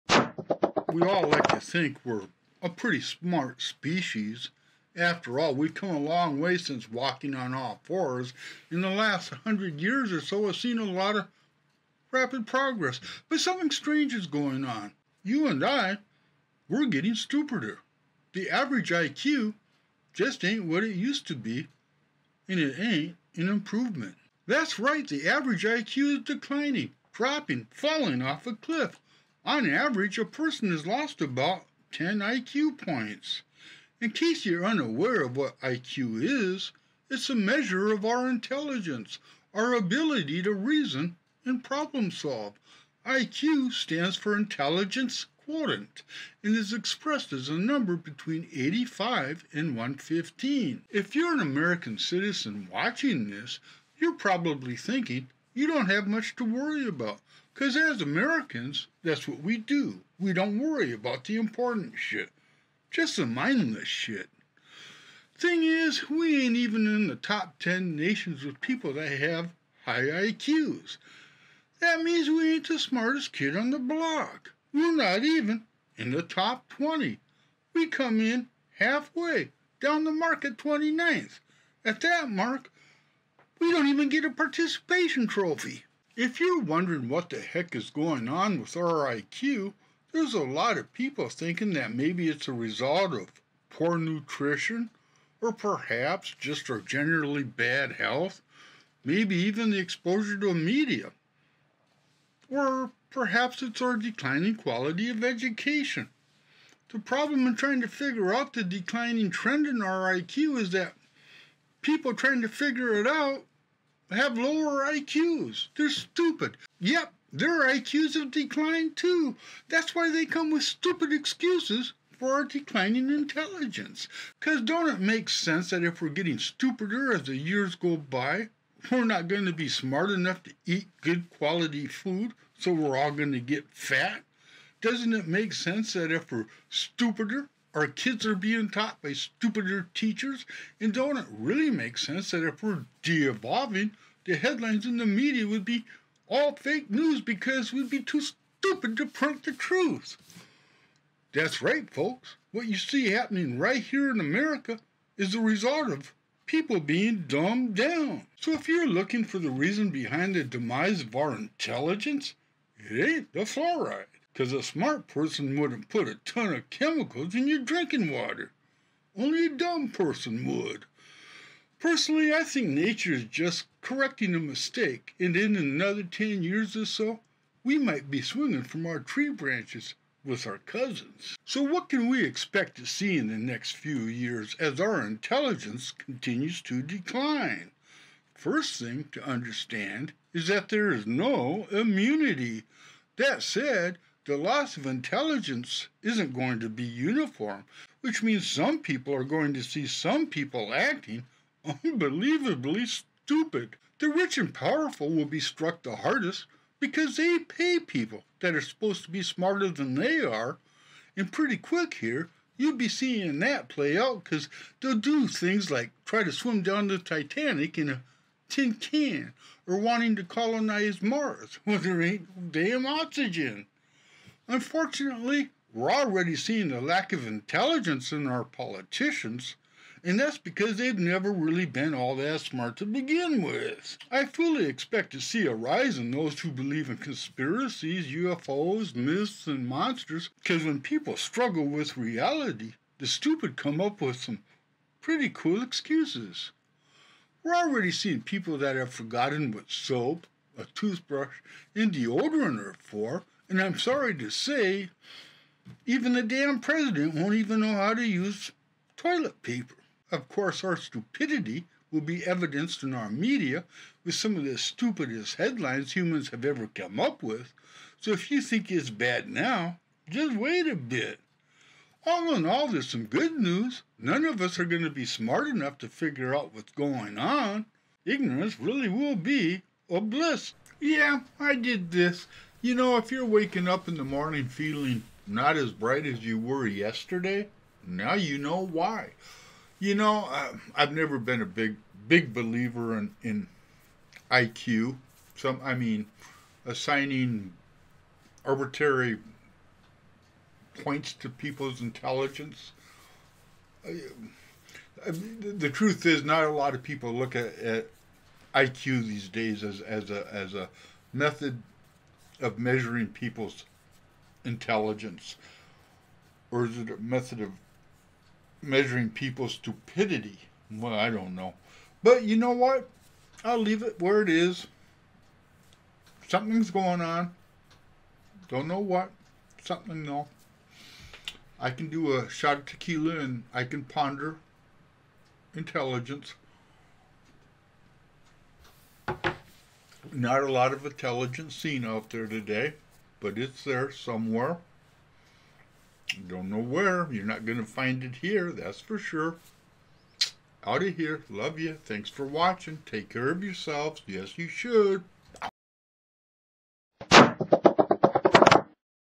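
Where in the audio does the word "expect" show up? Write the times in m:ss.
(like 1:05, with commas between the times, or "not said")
3:02, 3:54.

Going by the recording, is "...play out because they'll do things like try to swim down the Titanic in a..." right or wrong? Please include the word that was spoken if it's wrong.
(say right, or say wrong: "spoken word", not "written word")
right.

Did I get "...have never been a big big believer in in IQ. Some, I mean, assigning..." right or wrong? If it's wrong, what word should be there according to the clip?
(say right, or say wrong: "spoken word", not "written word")
right.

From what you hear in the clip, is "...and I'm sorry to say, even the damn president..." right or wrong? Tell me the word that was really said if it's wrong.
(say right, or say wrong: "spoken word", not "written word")
right.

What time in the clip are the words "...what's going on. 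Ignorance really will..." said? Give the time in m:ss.
4:36.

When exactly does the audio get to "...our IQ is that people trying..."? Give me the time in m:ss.
1:49.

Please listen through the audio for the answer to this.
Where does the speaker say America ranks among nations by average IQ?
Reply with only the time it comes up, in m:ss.
1:20.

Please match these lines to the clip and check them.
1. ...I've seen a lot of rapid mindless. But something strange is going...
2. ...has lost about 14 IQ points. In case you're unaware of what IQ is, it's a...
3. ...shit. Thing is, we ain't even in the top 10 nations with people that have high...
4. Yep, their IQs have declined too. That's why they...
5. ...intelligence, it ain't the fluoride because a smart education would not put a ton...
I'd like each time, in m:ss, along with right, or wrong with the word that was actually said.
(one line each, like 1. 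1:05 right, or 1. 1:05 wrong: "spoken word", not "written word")
1. 0:10 wrong: "progress", not "mindless"
2. 0:30 wrong: "10", not "14"
3. 1:03 right
4. 1:56 right
5. 2:41 wrong: "person", not "education".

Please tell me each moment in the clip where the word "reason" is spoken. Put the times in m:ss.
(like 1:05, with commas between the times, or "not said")
0:40, 2:39.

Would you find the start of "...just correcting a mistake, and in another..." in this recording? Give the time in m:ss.
2:53.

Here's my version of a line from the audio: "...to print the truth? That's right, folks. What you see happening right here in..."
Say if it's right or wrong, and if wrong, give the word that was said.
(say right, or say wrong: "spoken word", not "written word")
right.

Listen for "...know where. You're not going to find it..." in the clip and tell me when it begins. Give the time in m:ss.
5:46.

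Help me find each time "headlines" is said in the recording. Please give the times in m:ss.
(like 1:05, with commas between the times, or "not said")
2:24, 4:25.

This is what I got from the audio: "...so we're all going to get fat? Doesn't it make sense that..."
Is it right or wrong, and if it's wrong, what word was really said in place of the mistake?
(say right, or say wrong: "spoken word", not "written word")
right.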